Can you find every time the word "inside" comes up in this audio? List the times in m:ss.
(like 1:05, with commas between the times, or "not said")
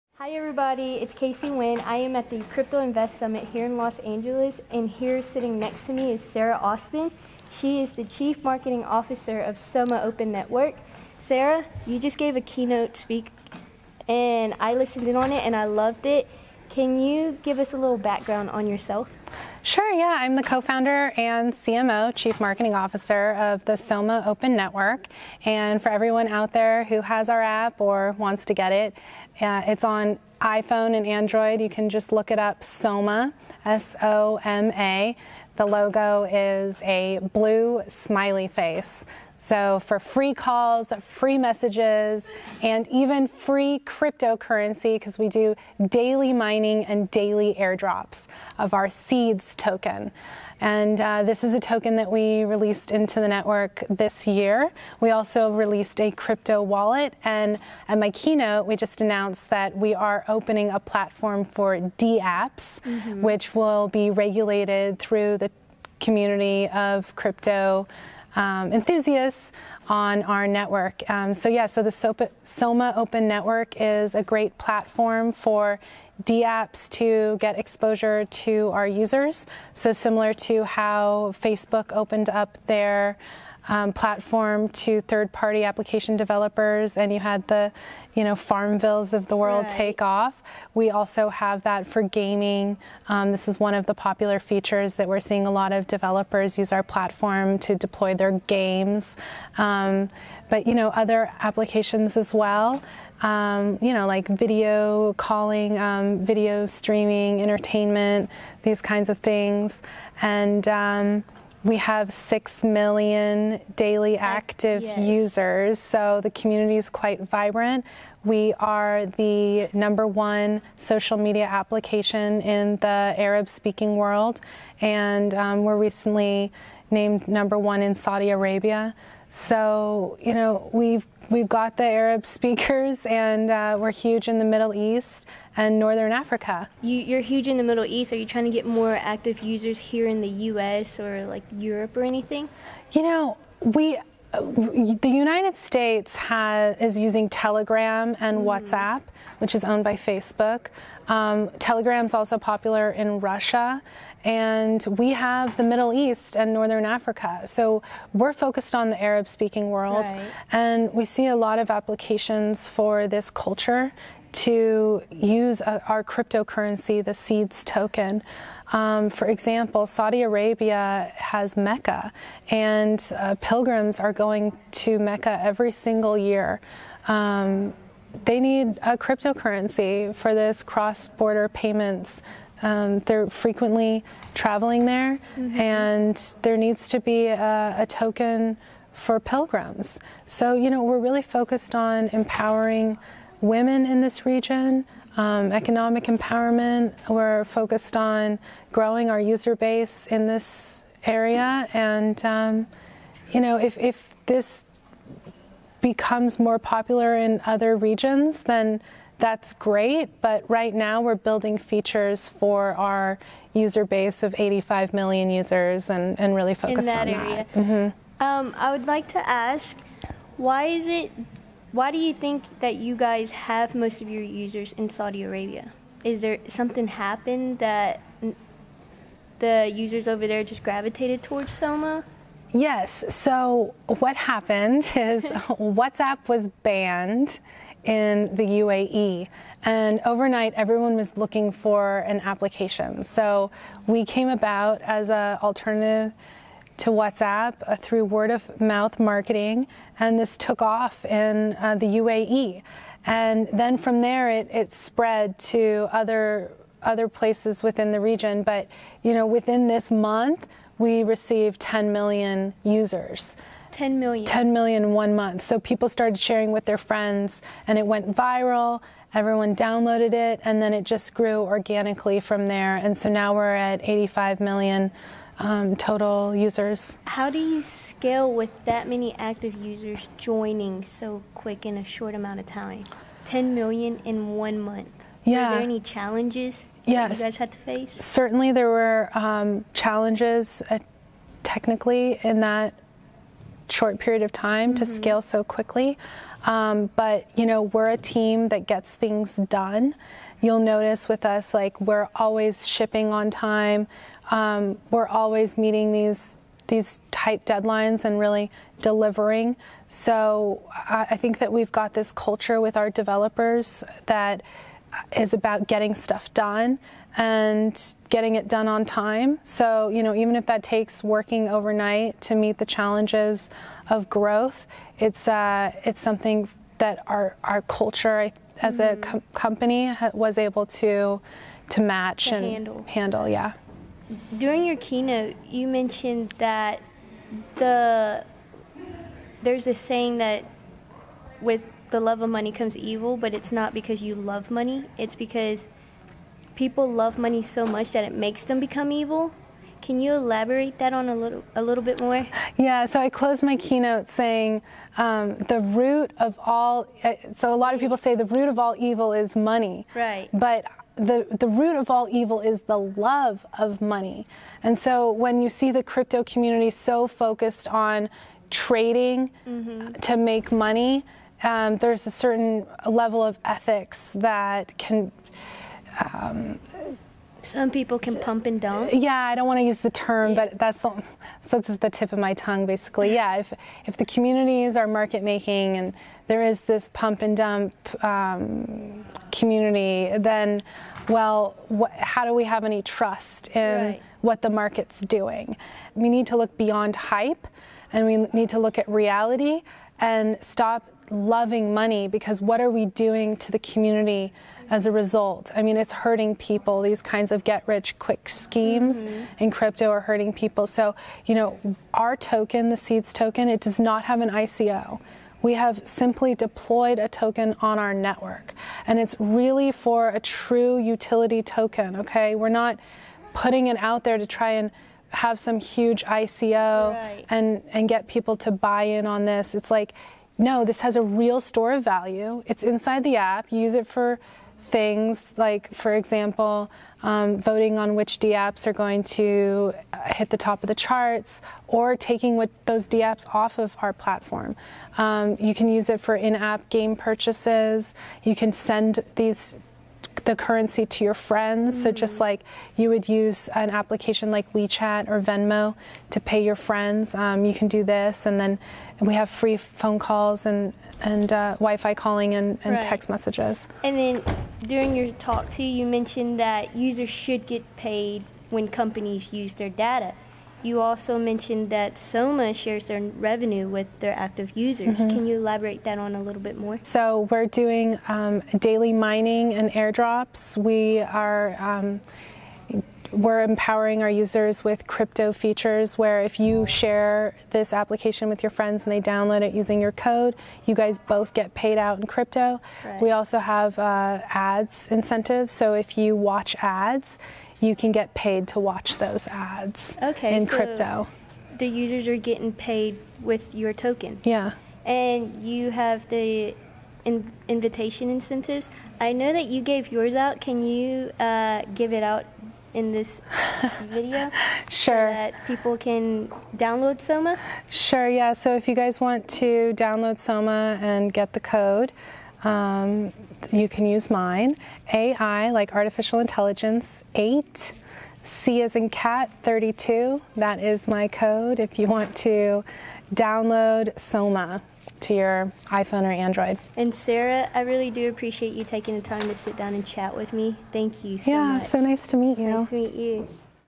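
7:12.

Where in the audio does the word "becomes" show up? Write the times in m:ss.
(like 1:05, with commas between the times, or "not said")
3:25, 5:48.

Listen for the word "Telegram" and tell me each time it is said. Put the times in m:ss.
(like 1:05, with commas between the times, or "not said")
2:27, 2:31.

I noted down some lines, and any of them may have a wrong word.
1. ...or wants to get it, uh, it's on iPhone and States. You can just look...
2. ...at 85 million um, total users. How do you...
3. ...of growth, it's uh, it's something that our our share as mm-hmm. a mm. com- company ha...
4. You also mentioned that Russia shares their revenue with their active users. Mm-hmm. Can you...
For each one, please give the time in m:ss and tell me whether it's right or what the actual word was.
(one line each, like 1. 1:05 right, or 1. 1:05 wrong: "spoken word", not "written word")
1. 0:27 wrong: "Android", not "States"
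2. 4:33 right
3. 5:23 wrong: "culture", not "share"
4. 7:50 wrong: "Soma", not "Russia".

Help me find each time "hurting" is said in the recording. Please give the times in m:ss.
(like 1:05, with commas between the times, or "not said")
6:45, 6:49.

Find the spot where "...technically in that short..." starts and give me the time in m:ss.
4:51.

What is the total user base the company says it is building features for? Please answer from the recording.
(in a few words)
85 million.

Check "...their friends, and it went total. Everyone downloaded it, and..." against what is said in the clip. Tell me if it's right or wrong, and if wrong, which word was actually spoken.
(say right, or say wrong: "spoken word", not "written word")
wrong: "viral", not "total".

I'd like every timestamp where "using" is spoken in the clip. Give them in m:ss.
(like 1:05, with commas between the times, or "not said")
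2:26, 8:09.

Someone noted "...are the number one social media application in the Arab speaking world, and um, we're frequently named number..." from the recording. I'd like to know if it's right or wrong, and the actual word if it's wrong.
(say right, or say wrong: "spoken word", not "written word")
wrong: "recently", not "frequently".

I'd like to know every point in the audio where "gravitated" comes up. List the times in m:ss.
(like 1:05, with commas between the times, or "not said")
3:50.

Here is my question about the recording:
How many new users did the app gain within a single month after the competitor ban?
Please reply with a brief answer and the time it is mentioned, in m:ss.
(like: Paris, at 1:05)
10 million, at 4:20.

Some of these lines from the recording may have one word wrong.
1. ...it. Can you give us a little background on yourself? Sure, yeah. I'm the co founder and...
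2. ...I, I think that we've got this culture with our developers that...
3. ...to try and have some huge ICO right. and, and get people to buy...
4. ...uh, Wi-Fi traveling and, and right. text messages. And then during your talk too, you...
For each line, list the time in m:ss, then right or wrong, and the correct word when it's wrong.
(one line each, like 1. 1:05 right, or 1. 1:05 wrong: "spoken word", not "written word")
1. 0:16 right
2. 5:10 right
3. 7:04 right
4. 7:41 wrong: "calling", not "traveling".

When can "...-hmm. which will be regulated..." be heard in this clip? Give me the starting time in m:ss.
1:03.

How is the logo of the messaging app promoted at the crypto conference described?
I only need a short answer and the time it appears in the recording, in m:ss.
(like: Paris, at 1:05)
Blue smiley face, at 0:37.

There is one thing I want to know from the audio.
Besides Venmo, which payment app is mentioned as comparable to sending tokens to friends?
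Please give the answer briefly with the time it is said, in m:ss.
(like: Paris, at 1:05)
WeChat, at 7:34.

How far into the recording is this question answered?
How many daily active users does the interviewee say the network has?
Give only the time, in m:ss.
1:52.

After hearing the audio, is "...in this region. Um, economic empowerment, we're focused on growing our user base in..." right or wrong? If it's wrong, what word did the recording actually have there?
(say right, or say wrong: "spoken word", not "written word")
right.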